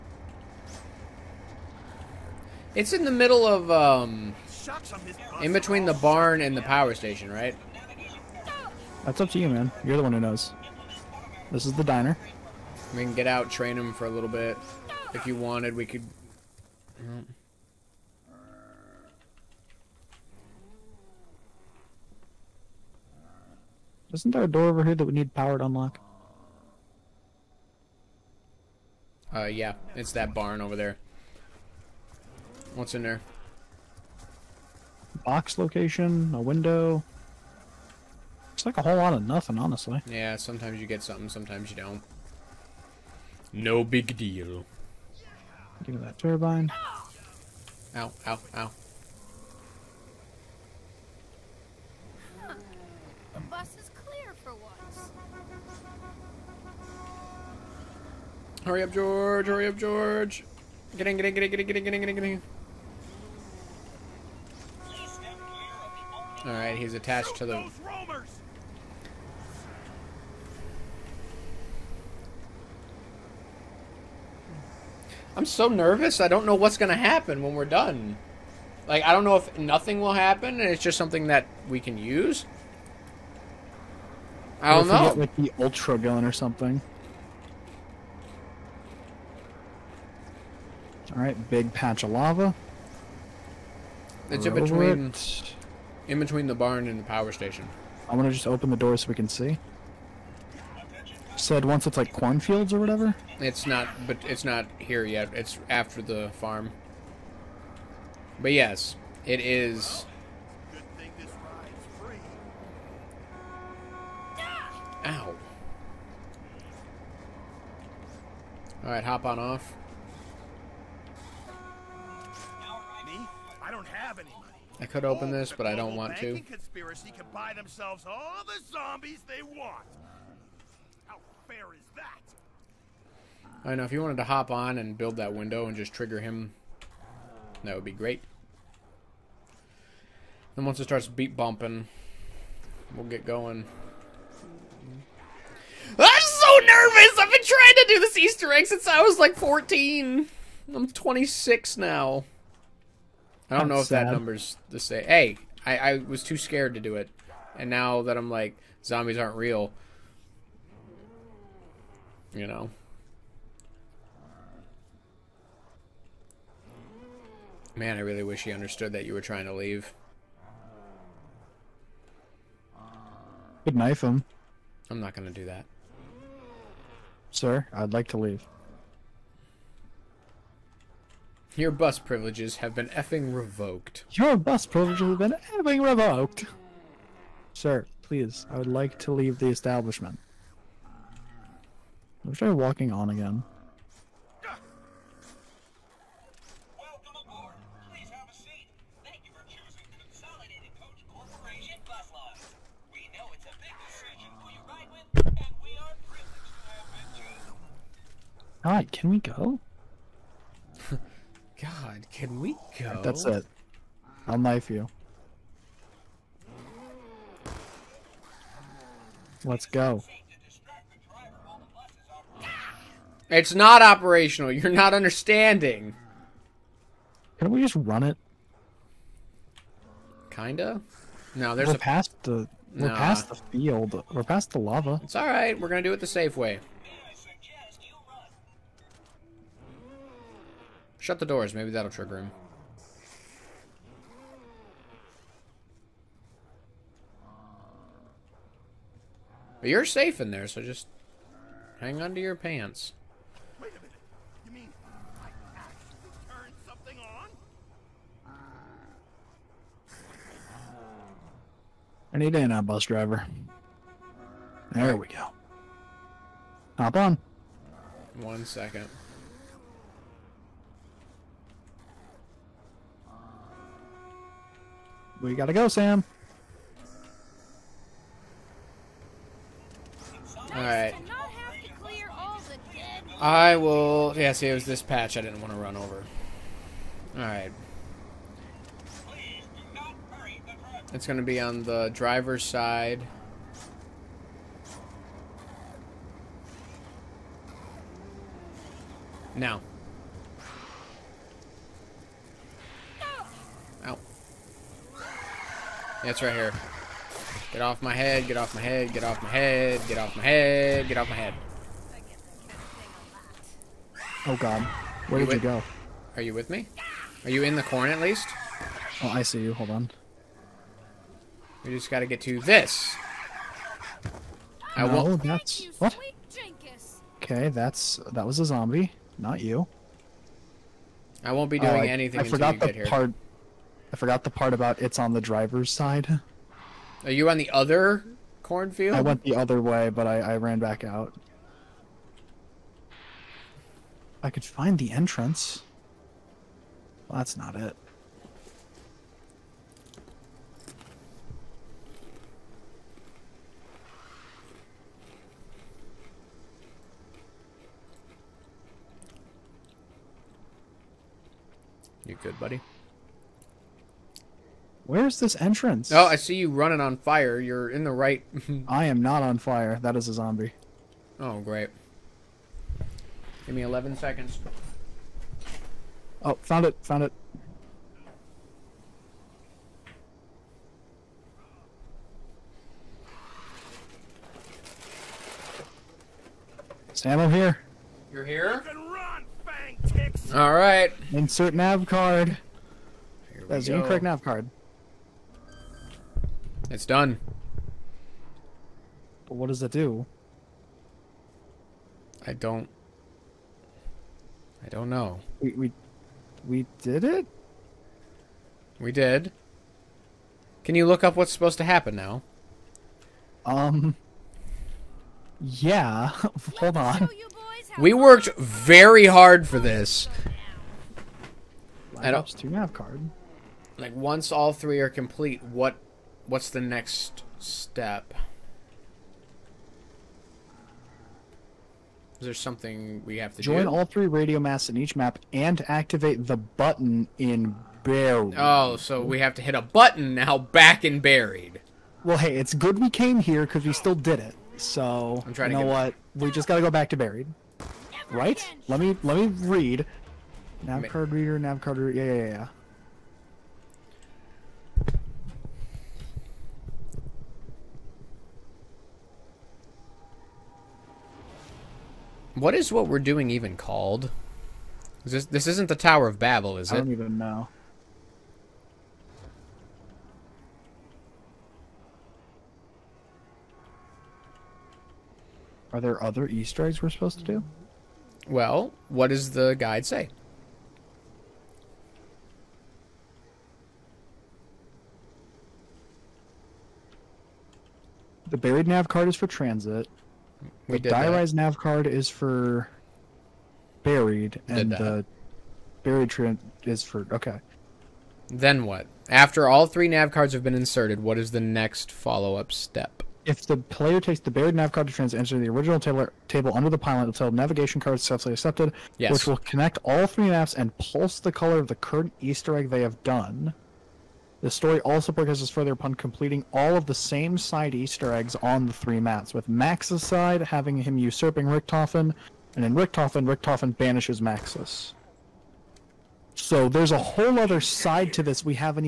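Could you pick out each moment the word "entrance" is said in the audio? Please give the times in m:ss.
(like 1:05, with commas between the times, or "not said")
5:44, 6:05.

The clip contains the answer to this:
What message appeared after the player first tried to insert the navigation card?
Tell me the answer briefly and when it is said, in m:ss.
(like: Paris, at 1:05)
Incorrect nav card, at 6:33.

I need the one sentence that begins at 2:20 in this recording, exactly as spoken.
Then once it starts beat bumping, we'll get going.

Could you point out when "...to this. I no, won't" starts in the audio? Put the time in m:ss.
5:22.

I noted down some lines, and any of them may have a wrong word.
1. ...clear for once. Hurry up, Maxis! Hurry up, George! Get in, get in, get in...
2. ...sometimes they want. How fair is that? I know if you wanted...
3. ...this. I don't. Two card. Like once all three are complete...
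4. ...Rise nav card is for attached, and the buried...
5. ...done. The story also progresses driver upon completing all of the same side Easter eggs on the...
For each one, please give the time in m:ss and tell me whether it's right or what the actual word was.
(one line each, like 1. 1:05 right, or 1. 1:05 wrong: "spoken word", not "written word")
1. 0:54 wrong: "George", not "Maxis"
2. 2:08 wrong: "zombies", not "sometimes"
3. 6:59 right
4. 8:11 wrong: "buried", not "attached"
5. 8:33 wrong: "further", not "driver".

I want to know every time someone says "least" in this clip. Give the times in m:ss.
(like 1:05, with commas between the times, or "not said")
5:17.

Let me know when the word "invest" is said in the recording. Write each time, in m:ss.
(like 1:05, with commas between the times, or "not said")
not said.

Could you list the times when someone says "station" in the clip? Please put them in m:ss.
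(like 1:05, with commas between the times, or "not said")
0:06, 1:37.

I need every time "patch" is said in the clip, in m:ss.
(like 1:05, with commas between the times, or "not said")
1:31, 4:44.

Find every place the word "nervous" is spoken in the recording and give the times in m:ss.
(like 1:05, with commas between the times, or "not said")
1:15, 2:26.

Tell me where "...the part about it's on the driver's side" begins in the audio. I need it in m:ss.
5:34.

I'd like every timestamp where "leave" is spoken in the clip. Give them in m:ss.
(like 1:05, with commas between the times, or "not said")
2:49, 2:58.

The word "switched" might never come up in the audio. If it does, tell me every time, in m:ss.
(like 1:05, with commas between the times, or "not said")
not said.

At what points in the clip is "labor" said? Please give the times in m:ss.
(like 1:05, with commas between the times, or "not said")
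not said.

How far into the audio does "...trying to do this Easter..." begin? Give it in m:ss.
2:27.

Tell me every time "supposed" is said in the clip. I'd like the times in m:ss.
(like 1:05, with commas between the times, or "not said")
6:51, 7:56.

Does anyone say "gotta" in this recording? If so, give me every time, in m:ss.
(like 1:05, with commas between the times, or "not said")
4:35, 5:21.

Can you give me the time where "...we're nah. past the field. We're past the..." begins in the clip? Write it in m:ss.
3:52.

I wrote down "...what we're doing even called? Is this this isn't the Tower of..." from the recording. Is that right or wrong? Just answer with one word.
right.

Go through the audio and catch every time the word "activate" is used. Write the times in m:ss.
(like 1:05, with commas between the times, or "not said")
7:15.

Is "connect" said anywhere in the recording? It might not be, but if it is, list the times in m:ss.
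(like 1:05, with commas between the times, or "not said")
8:29.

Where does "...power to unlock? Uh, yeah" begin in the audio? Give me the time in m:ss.
0:25.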